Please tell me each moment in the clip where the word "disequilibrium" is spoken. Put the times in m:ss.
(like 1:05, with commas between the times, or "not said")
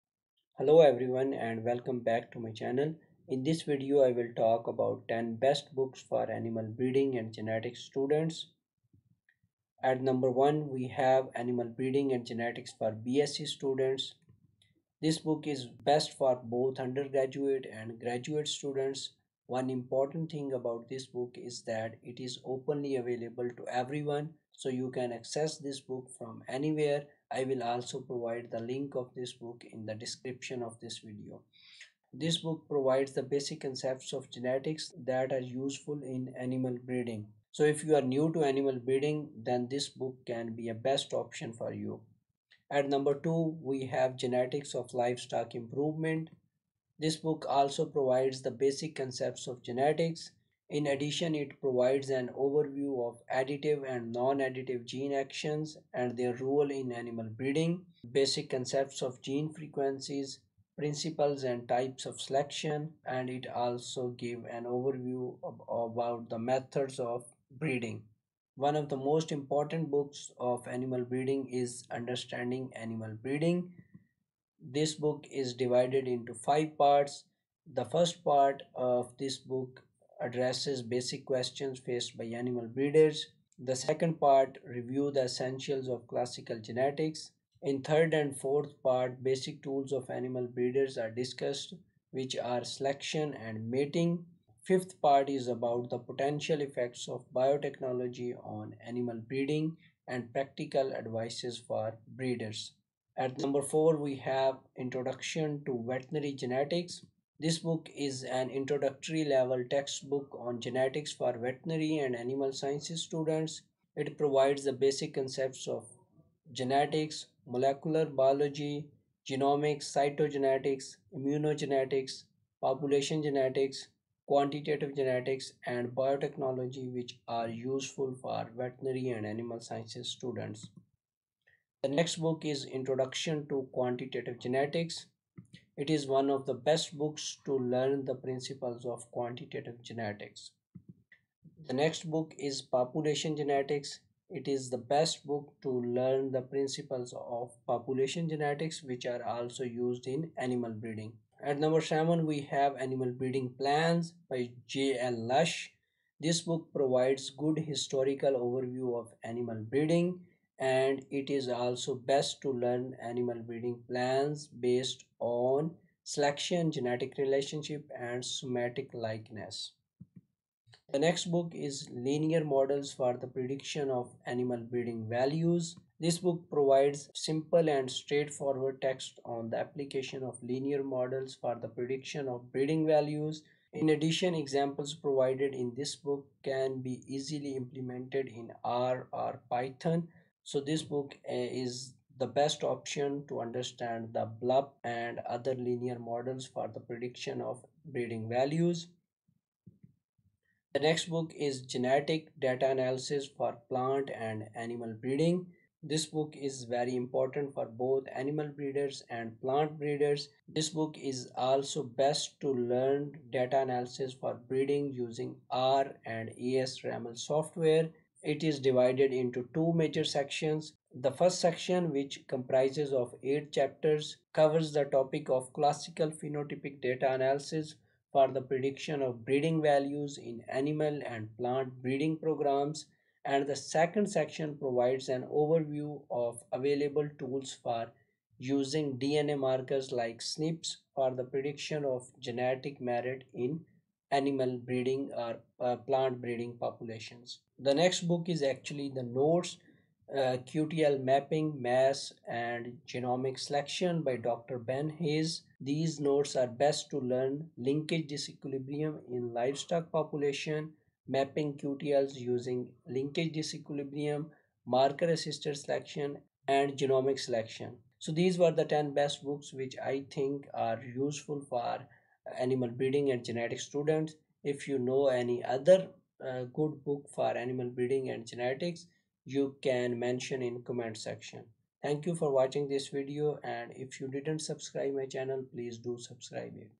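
4:18, 4:23.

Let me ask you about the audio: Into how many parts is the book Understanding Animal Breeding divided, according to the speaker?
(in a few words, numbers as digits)
5.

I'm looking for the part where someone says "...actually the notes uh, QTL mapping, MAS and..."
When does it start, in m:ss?
4:08.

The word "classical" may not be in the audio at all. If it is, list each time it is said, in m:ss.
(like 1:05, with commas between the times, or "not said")
1:26, 3:45.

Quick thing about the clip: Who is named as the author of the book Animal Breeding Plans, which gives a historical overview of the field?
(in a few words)
J.L. Lush.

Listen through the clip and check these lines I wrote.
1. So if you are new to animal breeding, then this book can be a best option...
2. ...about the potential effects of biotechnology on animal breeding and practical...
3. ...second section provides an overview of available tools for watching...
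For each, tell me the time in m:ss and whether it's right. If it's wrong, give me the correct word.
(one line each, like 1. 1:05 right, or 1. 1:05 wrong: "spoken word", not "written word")
1. 0:37 right
2. 1:35 right
3. 3:53 wrong: "using", not "watching".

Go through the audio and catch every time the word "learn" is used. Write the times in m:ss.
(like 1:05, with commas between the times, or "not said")
2:17, 2:25, 2:42, 3:32, 4:16.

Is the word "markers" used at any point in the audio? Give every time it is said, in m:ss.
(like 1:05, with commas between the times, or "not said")
3:59, 4:24.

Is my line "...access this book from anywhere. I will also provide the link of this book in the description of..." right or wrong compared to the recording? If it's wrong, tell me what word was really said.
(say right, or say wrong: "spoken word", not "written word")
right.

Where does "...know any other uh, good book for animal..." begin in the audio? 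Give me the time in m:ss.
4:34.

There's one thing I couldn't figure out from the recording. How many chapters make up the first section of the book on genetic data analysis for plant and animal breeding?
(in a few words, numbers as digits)
8.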